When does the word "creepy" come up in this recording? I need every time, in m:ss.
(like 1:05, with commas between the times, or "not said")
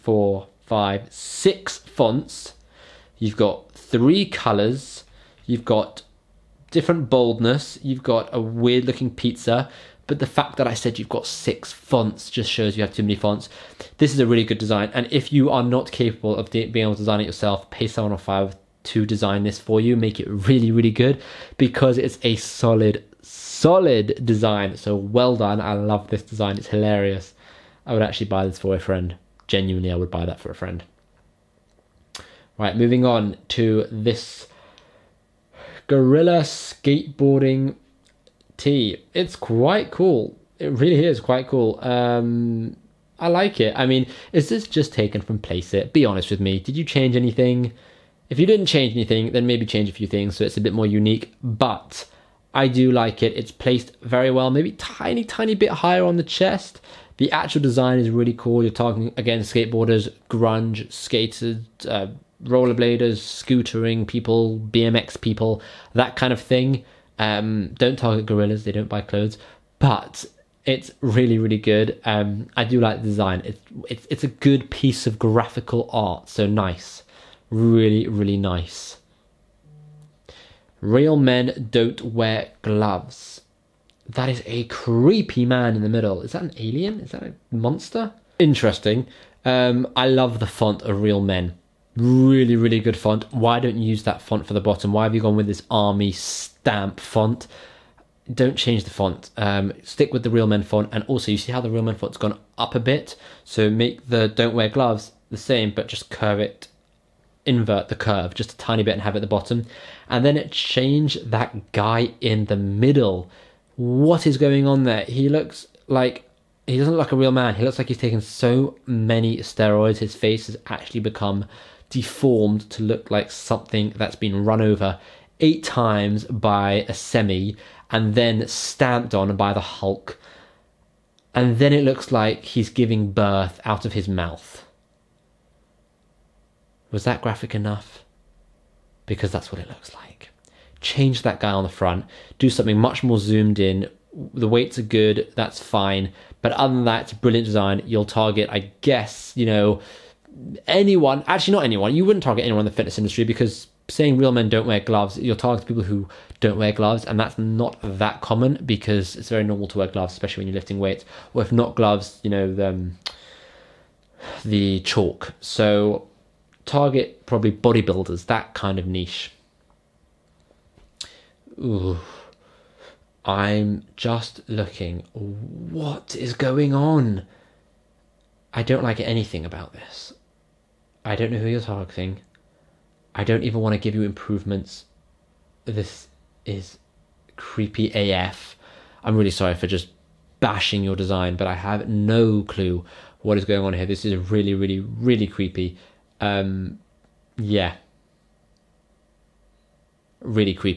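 1:24, 3:07, 3:15.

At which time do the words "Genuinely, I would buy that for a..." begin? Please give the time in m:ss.
0:29.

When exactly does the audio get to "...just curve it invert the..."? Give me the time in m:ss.
1:45.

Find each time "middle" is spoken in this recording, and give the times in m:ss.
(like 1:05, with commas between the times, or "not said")
1:25, 1:52.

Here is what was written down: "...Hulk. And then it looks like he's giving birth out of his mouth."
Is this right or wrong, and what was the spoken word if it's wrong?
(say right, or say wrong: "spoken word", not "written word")
right.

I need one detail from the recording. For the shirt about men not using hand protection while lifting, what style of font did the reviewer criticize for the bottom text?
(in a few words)
army stamp font.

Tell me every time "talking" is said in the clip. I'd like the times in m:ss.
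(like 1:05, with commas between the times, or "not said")
0:58.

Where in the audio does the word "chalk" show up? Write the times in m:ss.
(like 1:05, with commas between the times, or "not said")
2:44.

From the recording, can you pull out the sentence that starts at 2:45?
So target probably bodybuilders, that kind of niche.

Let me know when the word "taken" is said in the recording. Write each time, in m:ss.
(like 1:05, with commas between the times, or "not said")
0:44, 1:57.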